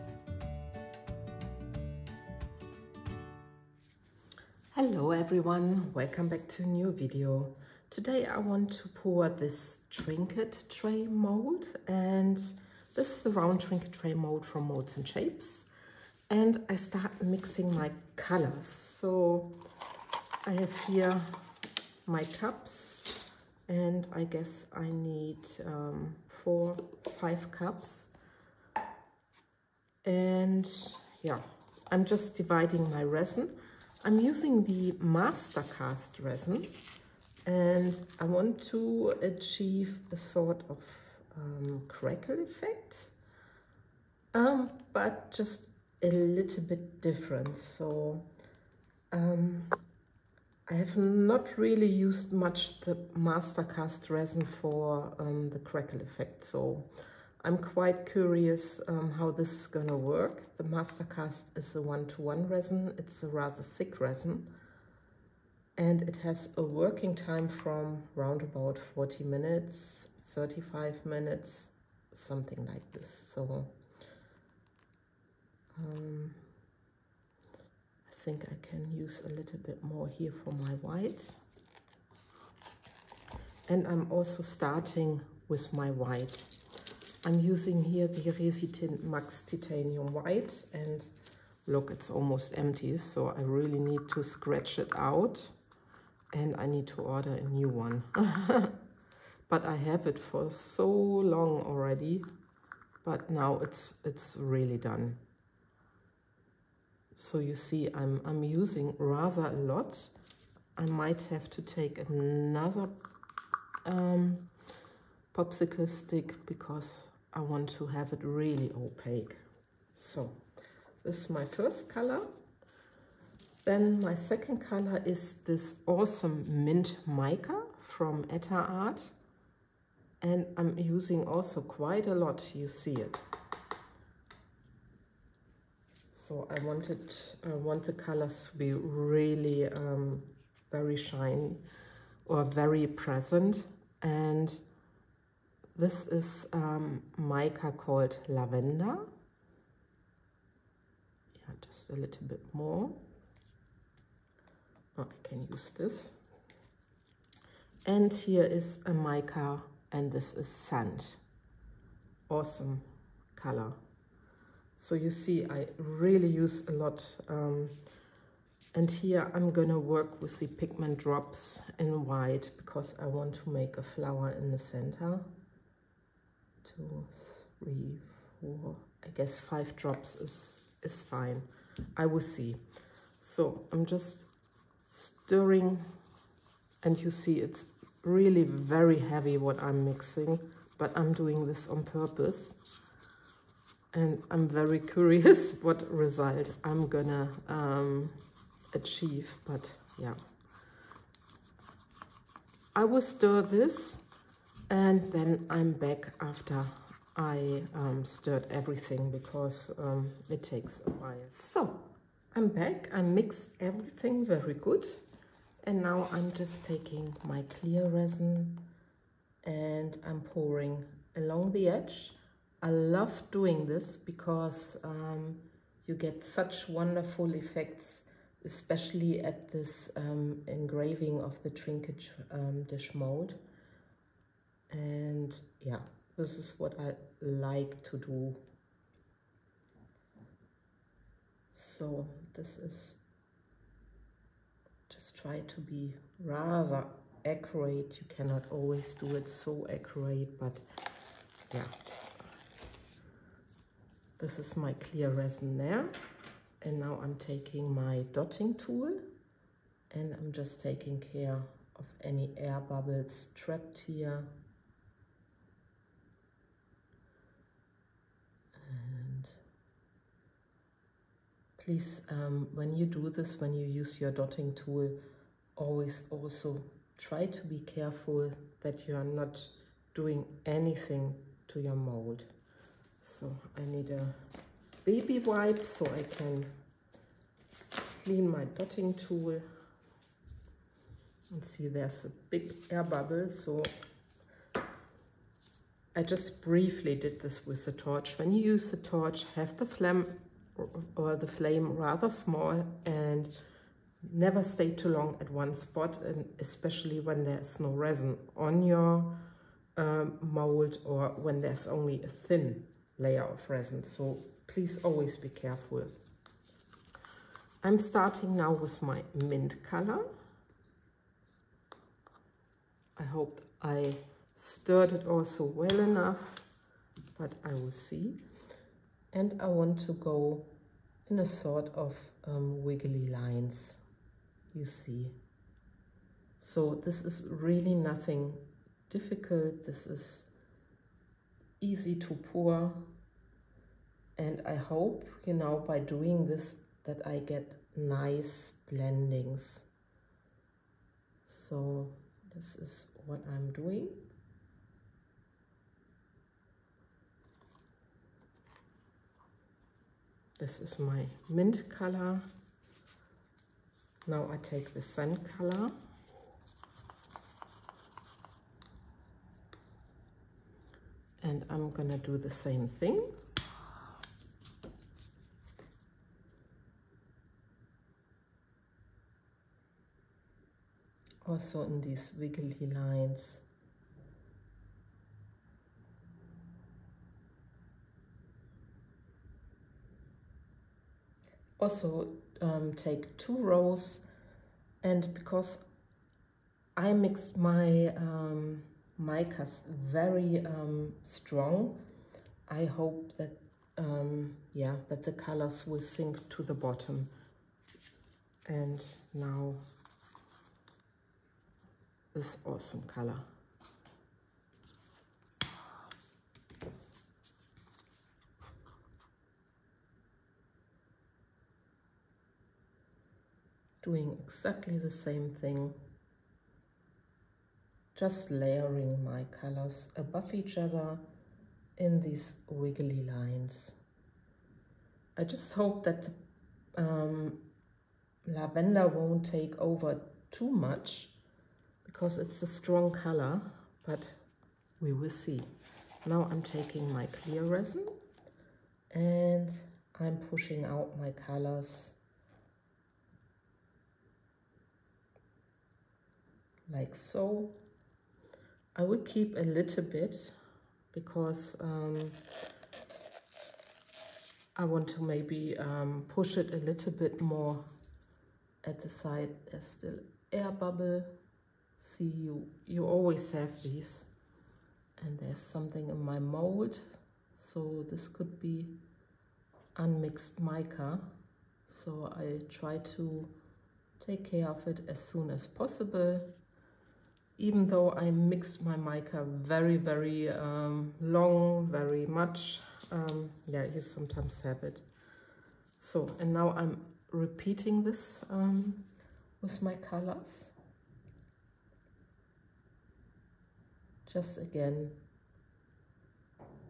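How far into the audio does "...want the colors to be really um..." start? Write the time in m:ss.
2:17.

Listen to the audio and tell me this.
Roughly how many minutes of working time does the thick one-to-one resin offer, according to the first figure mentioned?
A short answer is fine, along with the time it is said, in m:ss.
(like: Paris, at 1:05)
40, at 1:08.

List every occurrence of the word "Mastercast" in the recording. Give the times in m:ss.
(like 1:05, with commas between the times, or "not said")
0:35, 0:53, 1:00.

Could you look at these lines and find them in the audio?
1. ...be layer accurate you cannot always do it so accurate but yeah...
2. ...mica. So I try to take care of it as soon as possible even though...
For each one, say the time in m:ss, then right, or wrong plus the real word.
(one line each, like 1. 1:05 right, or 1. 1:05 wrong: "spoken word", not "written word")
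1. 4:05 wrong: "rather", not "layer"
2. 8:00 right.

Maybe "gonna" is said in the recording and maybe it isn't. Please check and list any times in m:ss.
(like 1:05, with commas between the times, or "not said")
2:49, 3:16, 6:11.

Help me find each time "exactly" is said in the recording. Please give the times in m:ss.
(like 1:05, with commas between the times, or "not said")
7:04.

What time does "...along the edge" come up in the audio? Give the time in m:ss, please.
3:41.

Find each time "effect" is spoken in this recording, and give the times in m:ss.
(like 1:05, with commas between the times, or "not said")
0:42, 0:56, 3:47.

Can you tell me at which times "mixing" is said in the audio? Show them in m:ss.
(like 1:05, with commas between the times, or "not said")
0:17, 3:09.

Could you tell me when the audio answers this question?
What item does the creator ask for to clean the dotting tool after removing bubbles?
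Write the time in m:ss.
4:44.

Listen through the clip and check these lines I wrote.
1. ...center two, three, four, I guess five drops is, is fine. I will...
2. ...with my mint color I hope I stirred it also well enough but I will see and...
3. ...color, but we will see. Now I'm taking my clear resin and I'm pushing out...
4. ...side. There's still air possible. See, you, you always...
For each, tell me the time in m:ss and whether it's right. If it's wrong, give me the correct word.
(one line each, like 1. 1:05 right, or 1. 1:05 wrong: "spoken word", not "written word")
1. 2:54 right
2. 5:18 right
3. 7:22 right
4. 7:48 wrong: "bubble", not "possible".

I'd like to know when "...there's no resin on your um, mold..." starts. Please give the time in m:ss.
5:07.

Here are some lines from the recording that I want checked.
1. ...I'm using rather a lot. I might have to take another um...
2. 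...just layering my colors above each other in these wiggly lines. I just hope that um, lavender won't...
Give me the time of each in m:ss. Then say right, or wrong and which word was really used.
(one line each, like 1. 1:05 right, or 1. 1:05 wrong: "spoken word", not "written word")
1. 1:48 right
2. 7:07 right.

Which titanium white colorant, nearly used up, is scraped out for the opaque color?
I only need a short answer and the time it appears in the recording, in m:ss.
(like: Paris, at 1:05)
Resitin Max Titanium White, at 1:28.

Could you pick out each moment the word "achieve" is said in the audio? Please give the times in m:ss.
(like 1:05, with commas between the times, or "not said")
0:39, 3:18.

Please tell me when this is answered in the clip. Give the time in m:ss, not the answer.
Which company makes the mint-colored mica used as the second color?
2:08.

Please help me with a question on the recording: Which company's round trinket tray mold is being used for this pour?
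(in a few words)
Molds and Shapes.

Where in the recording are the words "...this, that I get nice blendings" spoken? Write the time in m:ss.
5:46.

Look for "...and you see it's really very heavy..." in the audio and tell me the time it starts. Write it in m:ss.
3:06.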